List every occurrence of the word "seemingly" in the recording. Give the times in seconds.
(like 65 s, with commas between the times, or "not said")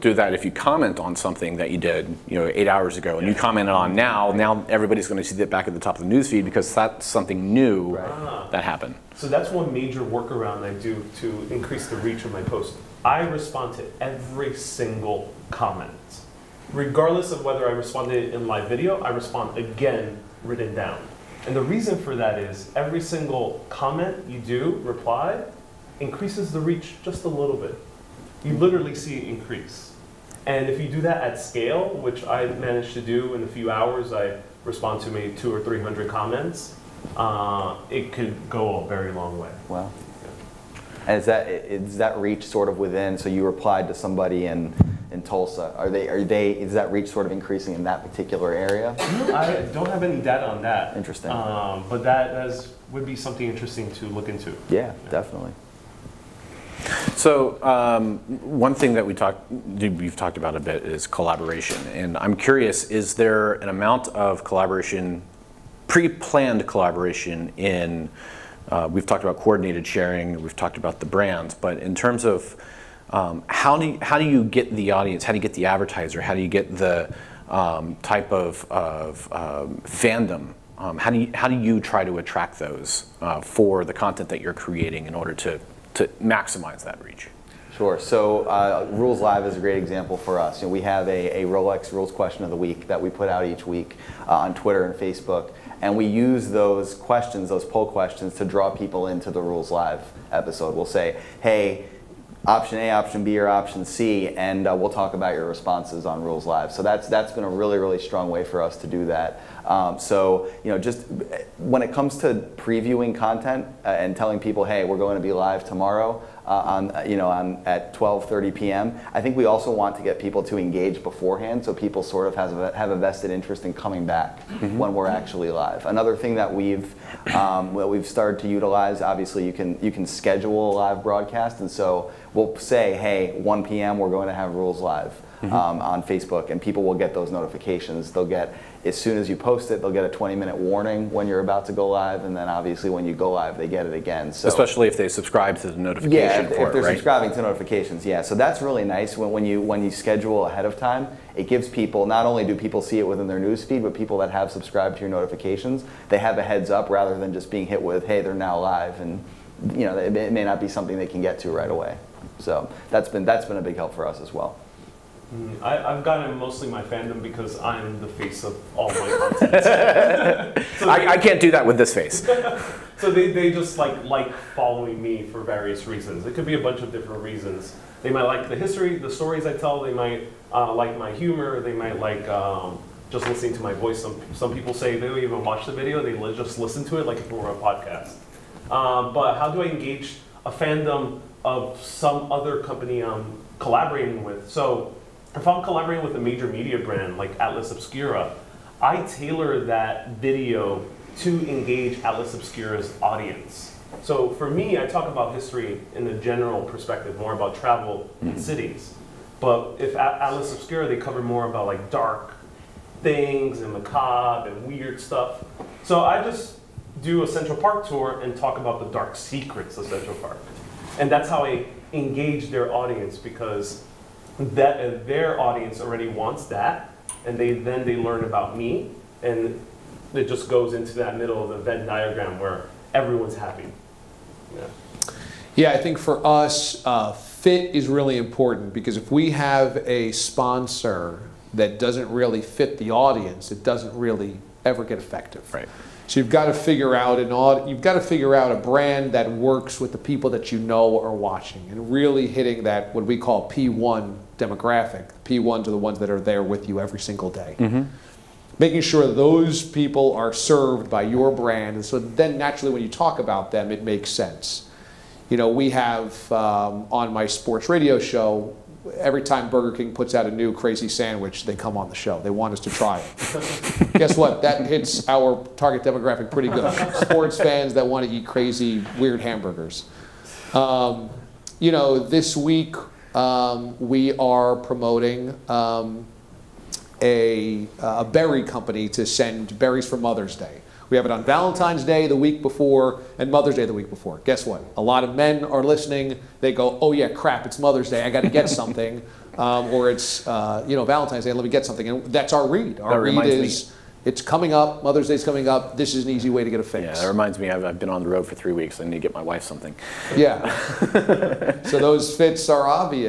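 not said.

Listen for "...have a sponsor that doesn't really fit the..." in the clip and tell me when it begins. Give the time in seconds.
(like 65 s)
239 s.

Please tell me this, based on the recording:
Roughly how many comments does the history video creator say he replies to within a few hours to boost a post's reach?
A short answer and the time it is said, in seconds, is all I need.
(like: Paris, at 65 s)
200 or 300, at 35 s.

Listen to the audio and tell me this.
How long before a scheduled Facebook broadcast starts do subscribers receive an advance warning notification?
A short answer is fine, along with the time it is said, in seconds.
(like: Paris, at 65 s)
20 minutes, at 140 s.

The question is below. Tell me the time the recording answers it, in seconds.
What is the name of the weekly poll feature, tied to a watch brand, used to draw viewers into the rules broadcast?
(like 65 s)
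91 s.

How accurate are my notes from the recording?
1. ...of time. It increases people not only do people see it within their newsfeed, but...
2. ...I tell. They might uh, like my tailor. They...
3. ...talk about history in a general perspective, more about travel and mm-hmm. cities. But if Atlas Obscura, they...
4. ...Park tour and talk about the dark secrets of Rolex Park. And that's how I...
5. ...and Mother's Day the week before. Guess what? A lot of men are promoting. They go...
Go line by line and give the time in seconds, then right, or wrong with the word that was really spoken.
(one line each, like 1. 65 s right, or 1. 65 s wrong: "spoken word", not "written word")
1. 150 s wrong: "gives", not "increases"
2. 179 s wrong: "humor", not "tailor"
3. 204 s right
4. 217 s wrong: "Central", not "Rolex"
5. 293 s wrong: "listening", not "promoting".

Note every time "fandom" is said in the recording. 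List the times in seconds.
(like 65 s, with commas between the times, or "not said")
79 s, 166 s, 190 s.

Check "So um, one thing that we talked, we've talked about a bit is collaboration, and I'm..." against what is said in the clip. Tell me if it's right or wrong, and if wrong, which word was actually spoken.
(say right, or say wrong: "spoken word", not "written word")
right.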